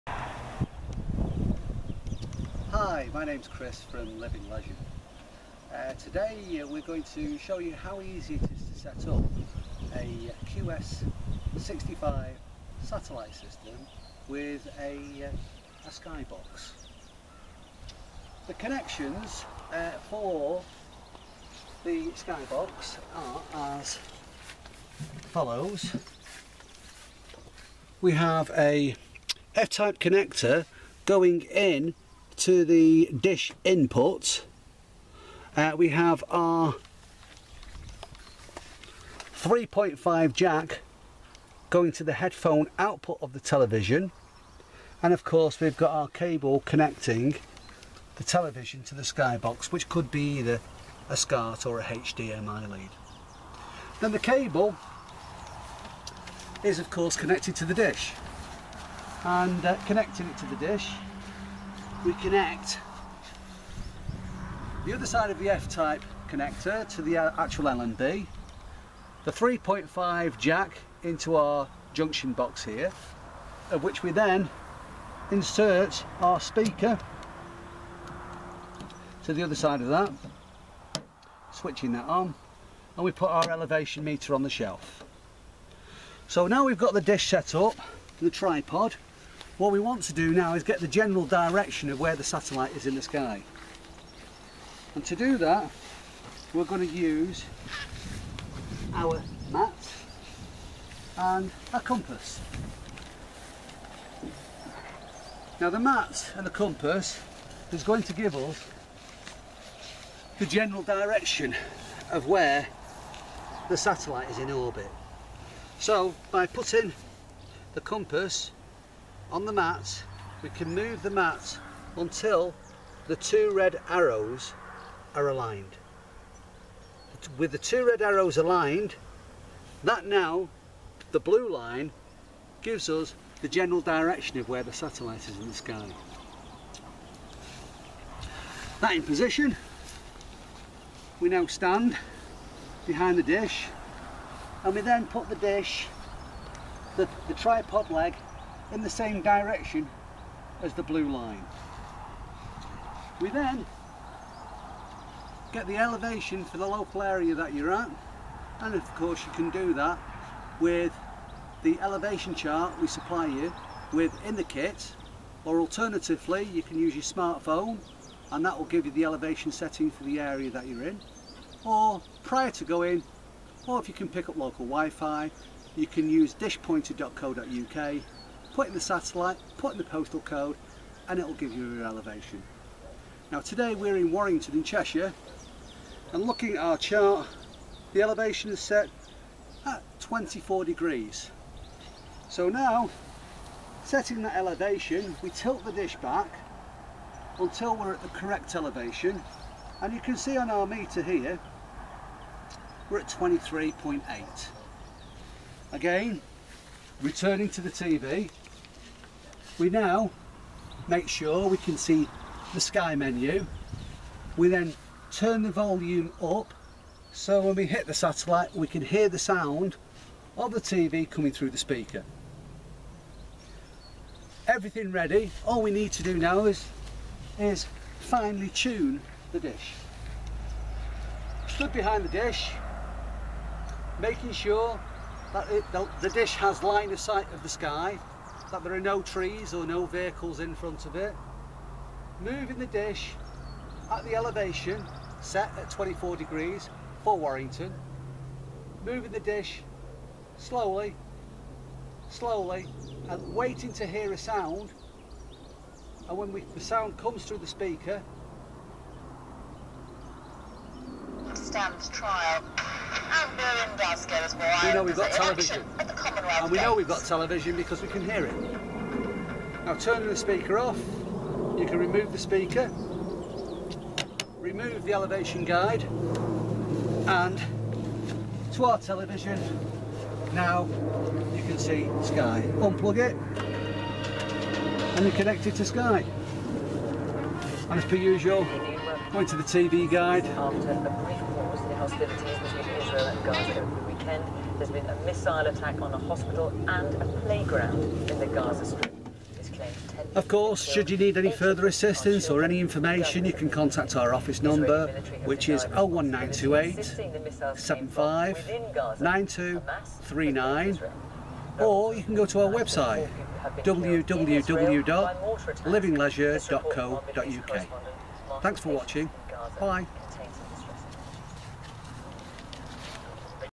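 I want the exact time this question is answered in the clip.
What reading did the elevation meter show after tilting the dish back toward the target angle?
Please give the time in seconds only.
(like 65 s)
203 s.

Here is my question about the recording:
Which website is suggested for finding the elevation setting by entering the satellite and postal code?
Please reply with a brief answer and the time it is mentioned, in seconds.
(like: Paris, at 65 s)
dishpointer.co.uk, at 176 s.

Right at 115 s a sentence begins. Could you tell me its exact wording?
So by putting the compass on the mat, we can move the mat until the two red arrows are aligned.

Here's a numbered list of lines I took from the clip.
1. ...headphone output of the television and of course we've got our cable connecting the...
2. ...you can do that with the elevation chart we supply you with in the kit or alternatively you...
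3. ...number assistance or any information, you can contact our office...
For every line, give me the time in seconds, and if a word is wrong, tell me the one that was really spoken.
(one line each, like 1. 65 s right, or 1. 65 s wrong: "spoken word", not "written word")
1. 42 s right
2. 159 s right
3. 301 s wrong: "further", not "number".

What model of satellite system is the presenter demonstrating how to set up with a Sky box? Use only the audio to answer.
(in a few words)
QS65.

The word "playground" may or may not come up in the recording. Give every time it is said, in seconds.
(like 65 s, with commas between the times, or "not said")
297 s.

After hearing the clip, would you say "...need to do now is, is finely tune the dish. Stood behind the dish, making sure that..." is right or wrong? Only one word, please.
right.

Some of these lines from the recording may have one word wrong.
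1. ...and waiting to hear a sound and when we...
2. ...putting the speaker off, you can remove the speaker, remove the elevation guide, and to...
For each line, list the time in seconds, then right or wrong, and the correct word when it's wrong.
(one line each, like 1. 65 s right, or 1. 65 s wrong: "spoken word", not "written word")
1. 253 s right
2. 269 s wrong: "turning", not "putting".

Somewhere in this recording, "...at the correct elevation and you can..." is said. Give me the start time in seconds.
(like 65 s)
197 s.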